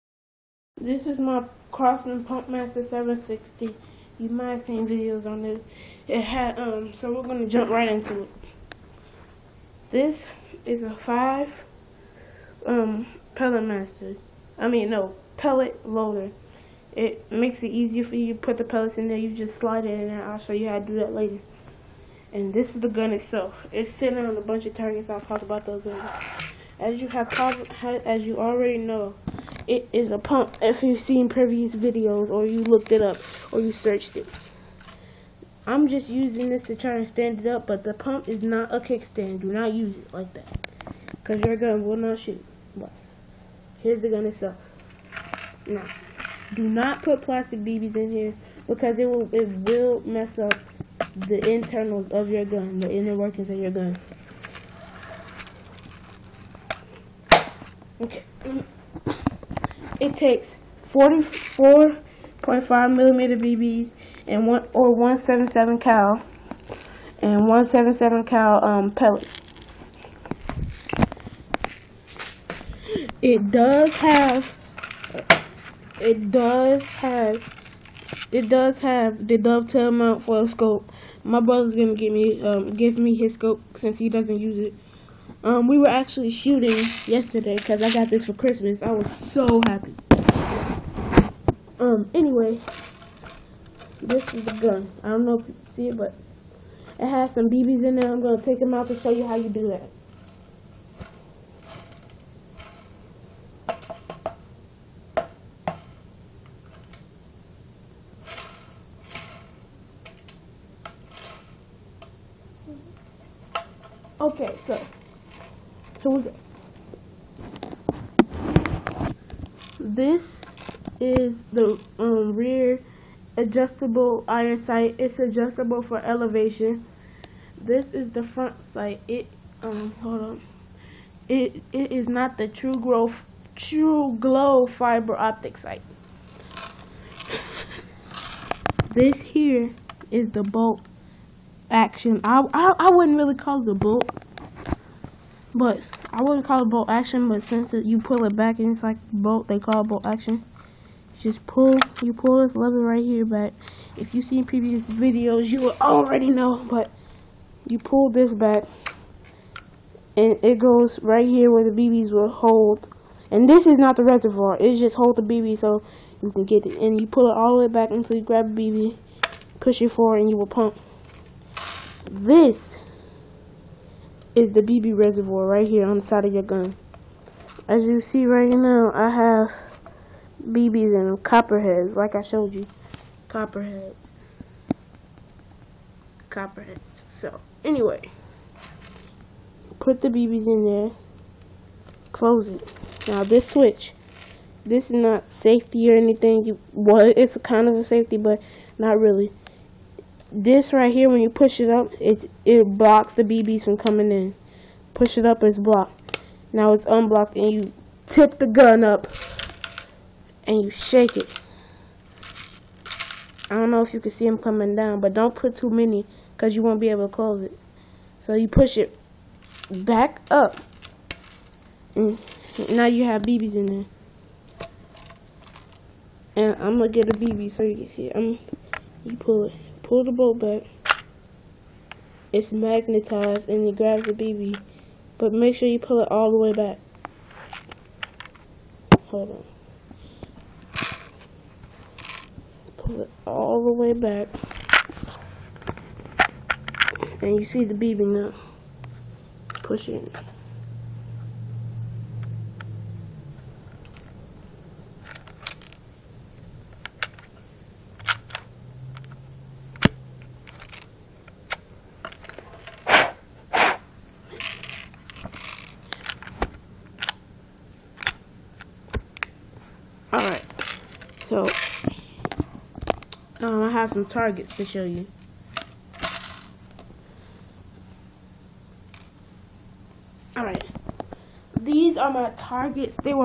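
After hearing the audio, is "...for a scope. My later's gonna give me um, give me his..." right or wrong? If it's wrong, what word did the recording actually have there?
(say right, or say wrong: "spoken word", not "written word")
wrong: "brother", not "later".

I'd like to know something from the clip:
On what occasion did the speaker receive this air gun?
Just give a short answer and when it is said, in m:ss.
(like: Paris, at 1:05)
Christmas, at 1:28.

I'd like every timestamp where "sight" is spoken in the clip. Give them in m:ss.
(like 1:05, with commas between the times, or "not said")
2:04, 2:08, 2:15.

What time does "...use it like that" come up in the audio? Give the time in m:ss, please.
0:39.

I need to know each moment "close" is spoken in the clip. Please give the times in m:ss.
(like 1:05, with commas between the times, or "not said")
3:12, 3:37.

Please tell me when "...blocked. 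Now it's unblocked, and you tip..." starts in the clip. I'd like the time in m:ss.
3:25.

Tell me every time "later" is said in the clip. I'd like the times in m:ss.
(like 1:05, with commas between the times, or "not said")
0:21, 0:25.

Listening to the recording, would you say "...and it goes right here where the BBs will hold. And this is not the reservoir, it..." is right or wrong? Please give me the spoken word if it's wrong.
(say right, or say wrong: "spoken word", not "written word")
right.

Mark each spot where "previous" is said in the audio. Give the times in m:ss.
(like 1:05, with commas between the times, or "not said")
0:31, 2:34.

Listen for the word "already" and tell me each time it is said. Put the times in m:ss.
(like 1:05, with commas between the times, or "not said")
0:28, 2:35.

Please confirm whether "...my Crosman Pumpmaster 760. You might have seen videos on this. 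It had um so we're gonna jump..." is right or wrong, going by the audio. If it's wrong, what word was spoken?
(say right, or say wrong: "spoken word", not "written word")
right.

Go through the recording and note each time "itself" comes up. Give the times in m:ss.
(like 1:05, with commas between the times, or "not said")
0:23, 0:44.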